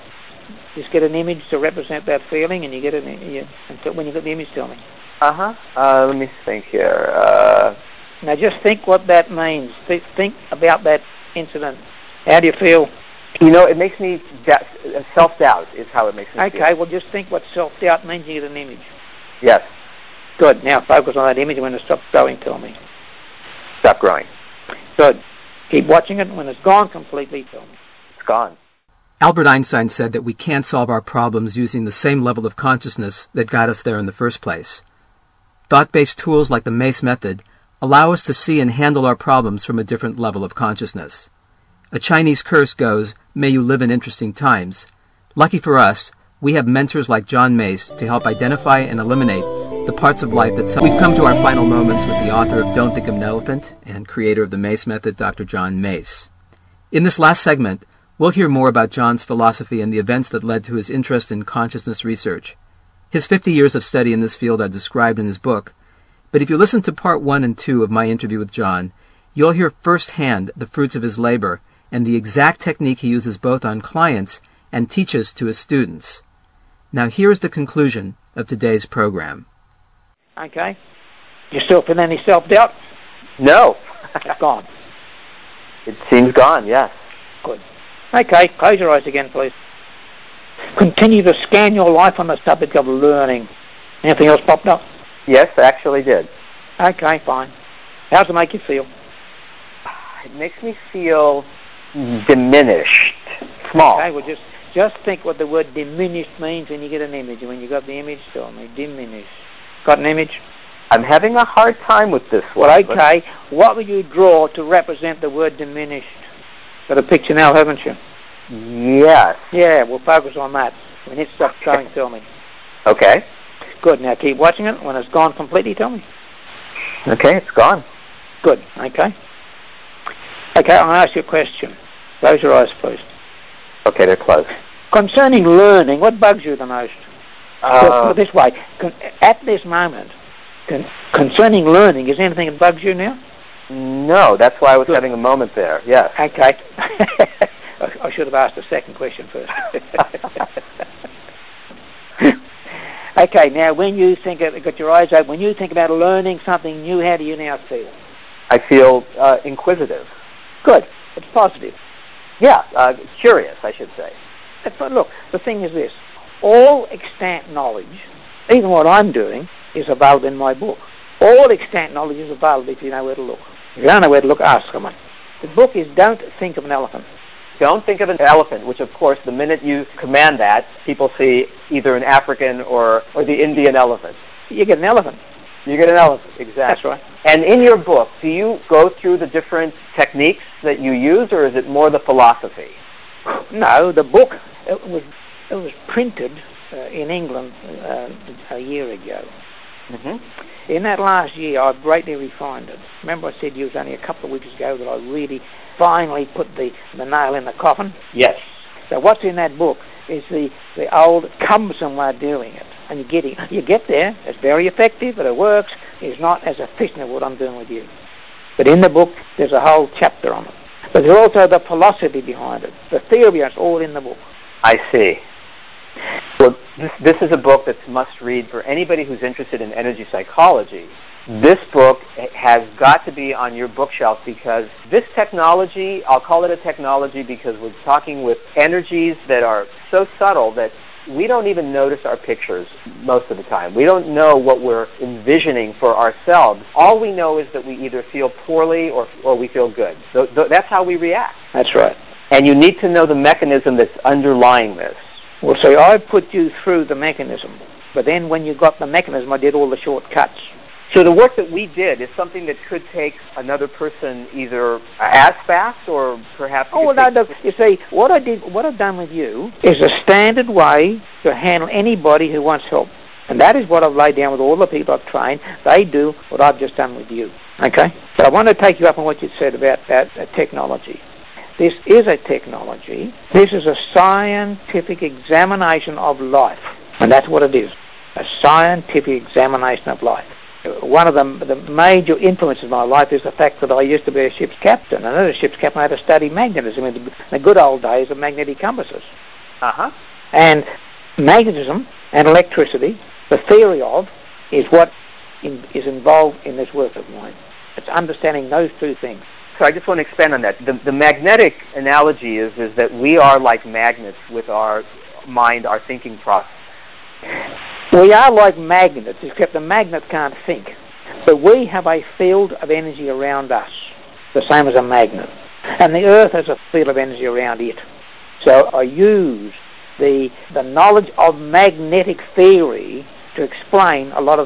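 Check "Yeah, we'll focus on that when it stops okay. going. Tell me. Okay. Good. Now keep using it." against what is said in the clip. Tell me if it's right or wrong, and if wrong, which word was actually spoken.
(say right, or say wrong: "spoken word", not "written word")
wrong: "watching", not "using".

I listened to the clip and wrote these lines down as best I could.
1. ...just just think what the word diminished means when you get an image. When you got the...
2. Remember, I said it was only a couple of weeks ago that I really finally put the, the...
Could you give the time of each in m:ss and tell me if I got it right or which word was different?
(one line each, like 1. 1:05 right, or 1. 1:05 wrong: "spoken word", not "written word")
1. 1:44 right
2. 3:23 right.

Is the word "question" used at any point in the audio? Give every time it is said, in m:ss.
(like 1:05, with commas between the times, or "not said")
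2:11, 2:28.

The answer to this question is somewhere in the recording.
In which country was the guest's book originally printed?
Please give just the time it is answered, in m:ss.
3:17.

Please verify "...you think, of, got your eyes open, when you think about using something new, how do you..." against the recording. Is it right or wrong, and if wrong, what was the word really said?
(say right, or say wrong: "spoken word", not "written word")
wrong: "learning", not "using".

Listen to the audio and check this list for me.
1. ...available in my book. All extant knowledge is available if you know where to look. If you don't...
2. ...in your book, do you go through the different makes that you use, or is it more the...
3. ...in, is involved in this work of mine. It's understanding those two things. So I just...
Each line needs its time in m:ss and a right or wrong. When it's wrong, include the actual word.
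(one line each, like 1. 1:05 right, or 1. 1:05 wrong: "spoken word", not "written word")
1. 2:49 right
2. 3:07 wrong: "techniques", not "makes"
3. 5:05 right.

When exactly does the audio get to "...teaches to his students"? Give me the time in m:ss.
1:14.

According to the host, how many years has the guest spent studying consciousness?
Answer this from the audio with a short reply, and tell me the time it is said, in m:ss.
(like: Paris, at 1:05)
50, at 1:03.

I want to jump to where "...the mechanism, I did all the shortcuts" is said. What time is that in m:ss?
4:18.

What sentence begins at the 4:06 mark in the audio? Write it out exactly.
All we know is that we either feel poorly or, or we feel good.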